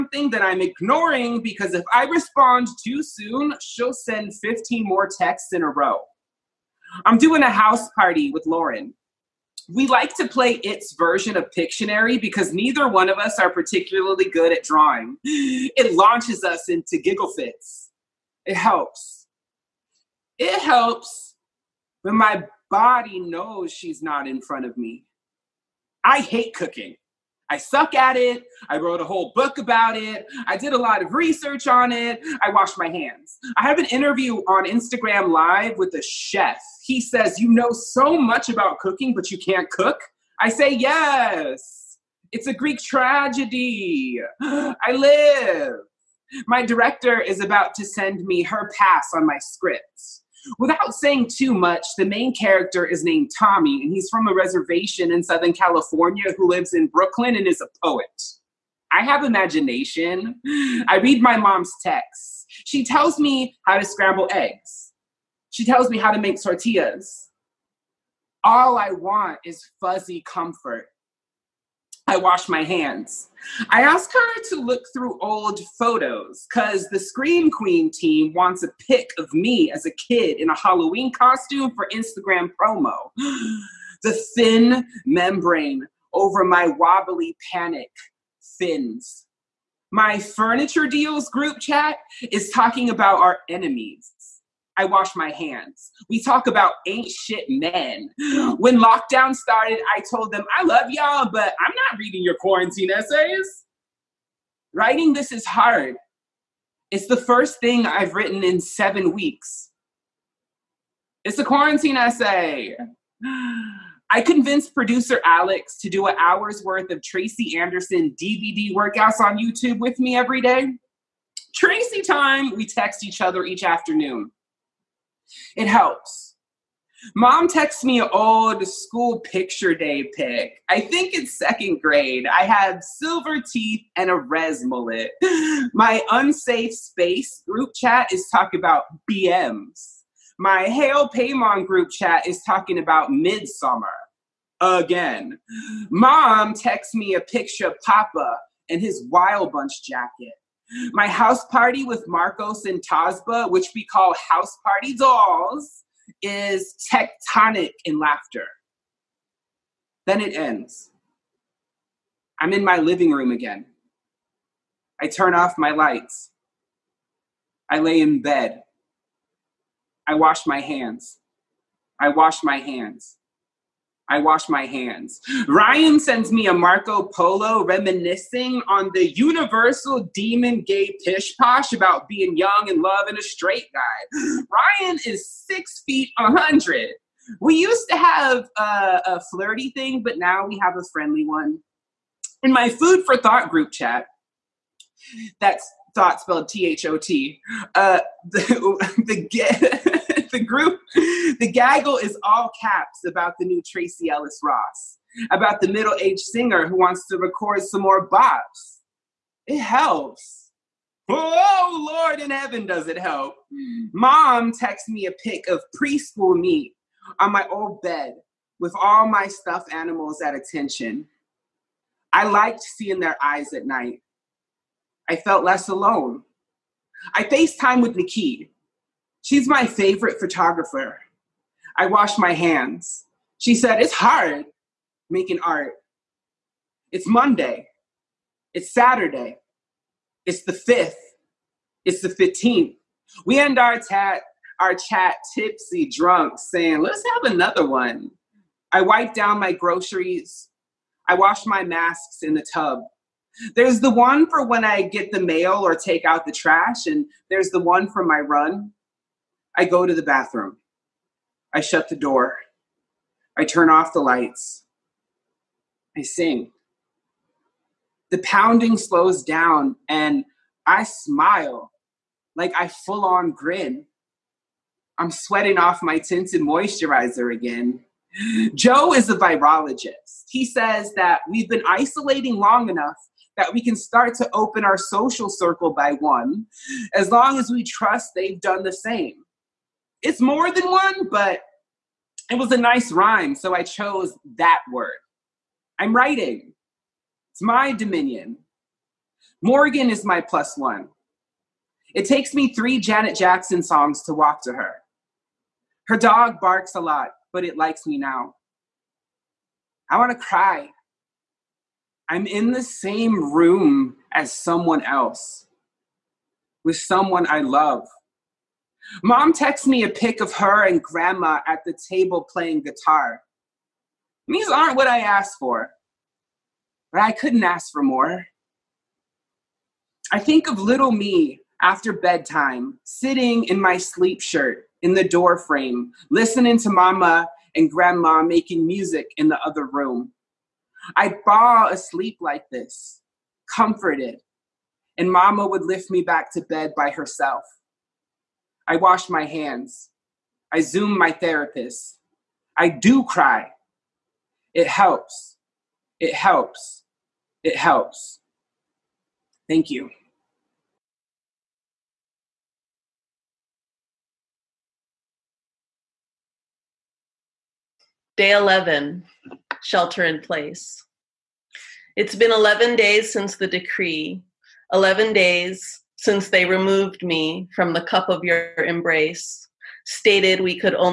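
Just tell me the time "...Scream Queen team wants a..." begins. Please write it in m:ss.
1:16.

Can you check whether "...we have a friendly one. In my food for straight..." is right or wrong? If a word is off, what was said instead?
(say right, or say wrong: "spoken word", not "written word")
wrong: "thought", not "straight".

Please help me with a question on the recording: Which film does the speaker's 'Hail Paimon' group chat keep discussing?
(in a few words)
Midsommar.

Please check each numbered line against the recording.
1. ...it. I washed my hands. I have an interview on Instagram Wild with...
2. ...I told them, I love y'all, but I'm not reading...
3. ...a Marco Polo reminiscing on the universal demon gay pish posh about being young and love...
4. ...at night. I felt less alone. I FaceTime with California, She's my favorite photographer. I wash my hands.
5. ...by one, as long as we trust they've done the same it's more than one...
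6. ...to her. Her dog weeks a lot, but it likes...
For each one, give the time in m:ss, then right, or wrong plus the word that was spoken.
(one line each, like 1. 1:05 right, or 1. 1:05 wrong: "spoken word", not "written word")
1. 0:31 wrong: "Live", not "Wild"
2. 1:39 right
3. 2:56 right
4. 3:43 wrong: "Nikki", not "California"
5. 4:45 right
6. 5:04 wrong: "barks", not "weeks".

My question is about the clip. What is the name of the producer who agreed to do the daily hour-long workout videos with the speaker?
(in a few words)
Alex.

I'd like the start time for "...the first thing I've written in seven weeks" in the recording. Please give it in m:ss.
1:47.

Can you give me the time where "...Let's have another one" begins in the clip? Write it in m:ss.
4:06.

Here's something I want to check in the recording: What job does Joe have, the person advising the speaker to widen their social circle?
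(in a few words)
Virologist.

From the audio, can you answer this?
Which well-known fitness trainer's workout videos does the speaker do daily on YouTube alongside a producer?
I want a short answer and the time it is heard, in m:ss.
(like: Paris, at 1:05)
Tracy Anderson, at 1:57.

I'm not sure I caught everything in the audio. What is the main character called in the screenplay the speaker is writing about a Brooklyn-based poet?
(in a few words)
Tommy.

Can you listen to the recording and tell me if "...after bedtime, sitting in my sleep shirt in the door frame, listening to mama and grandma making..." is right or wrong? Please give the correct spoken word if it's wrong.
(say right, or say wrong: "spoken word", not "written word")
right.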